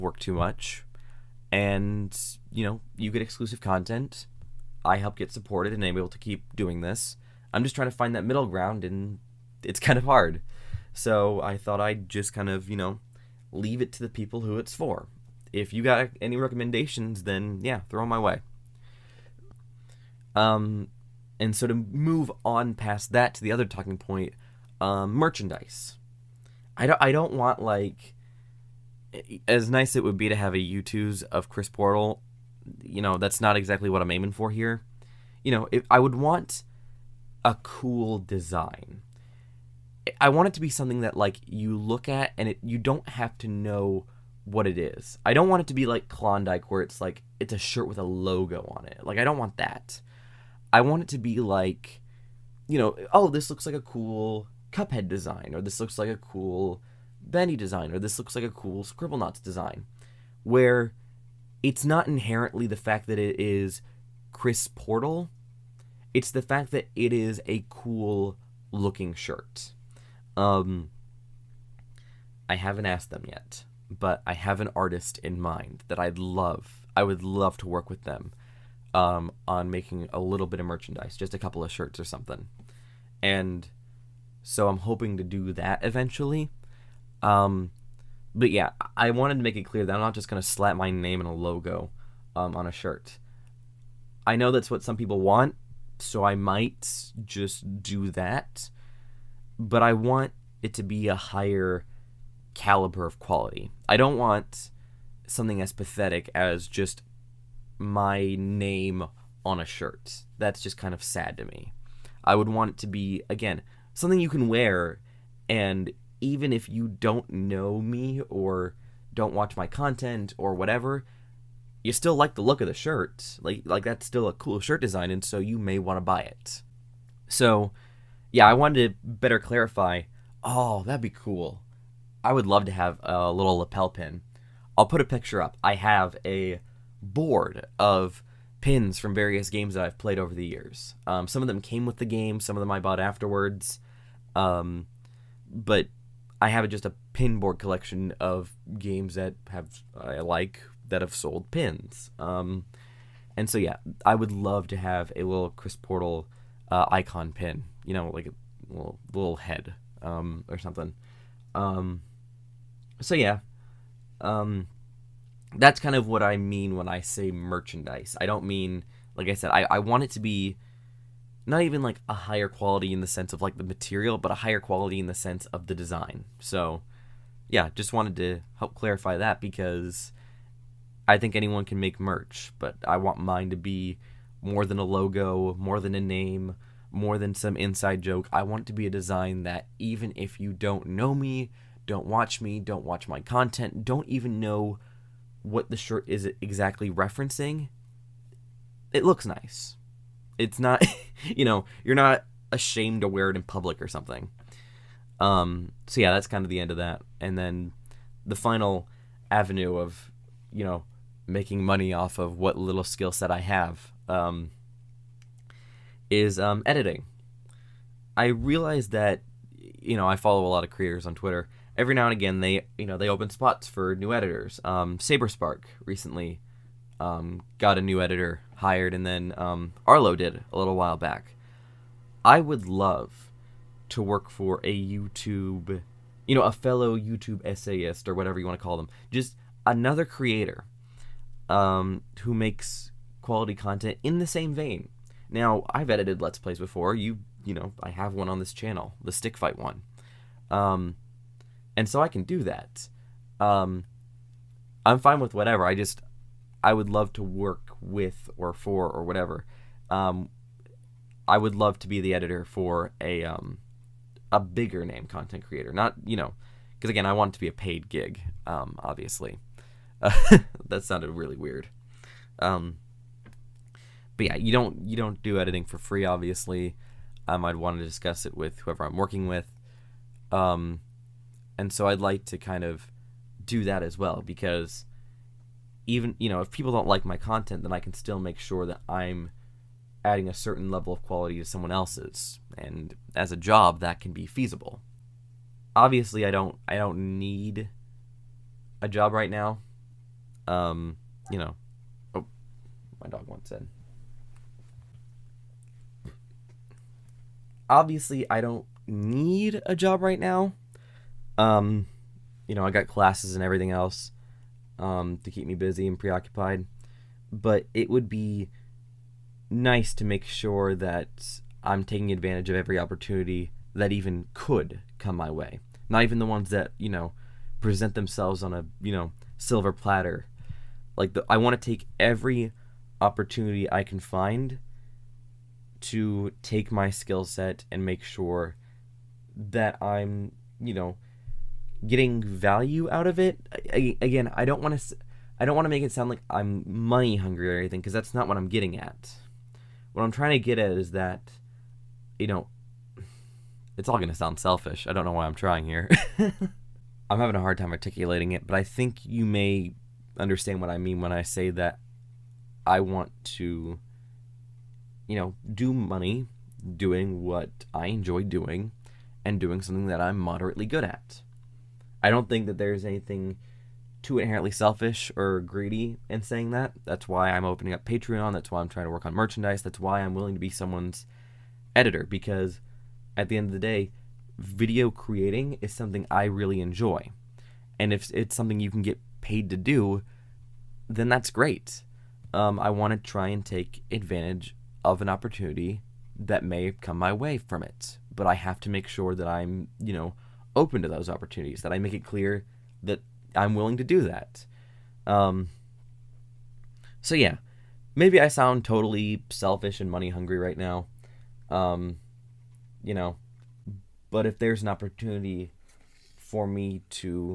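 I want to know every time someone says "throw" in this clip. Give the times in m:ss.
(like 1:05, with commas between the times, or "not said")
0:17.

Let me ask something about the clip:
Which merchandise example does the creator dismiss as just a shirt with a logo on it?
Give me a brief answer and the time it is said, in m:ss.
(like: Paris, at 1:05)
Klondike, at 0:46.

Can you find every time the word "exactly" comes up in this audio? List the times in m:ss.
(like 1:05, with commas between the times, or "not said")
0:33, 3:16.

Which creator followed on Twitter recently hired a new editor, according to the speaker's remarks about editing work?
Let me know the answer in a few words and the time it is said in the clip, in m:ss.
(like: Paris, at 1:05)
SaberSpark, at 3:44.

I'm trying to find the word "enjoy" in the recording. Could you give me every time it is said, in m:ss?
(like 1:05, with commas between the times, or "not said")
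6:07, 6:26.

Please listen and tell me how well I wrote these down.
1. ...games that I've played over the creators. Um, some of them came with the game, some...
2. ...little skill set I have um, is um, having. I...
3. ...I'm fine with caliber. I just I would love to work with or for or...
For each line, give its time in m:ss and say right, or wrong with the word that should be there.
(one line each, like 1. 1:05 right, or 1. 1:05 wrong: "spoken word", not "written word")
1. 2:19 wrong: "years", not "creators"
2. 3:32 wrong: "editing", not "having"
3. 4:14 wrong: "whatever", not "caliber".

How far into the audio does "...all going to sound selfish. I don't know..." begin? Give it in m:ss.
5:53.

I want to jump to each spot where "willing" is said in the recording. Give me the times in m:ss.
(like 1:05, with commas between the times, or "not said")
6:20, 6:43.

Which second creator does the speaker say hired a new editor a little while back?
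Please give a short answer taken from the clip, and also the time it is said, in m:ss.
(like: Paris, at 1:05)
Arlo, at 3:49.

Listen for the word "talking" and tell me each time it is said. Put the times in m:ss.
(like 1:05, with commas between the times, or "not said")
0:23.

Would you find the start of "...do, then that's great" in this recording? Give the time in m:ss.
6:29.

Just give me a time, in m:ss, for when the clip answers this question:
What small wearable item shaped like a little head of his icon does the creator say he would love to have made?
2:13.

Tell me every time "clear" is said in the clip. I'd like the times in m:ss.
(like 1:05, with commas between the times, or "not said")
1:29, 6:42.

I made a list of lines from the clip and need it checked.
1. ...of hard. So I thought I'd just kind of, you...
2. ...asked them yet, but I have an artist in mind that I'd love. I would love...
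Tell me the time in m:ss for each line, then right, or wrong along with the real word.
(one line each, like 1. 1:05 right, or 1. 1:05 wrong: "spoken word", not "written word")
1. 0:09 right
2. 1:12 right.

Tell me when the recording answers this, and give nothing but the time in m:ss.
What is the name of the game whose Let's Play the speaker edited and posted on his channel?
4:09.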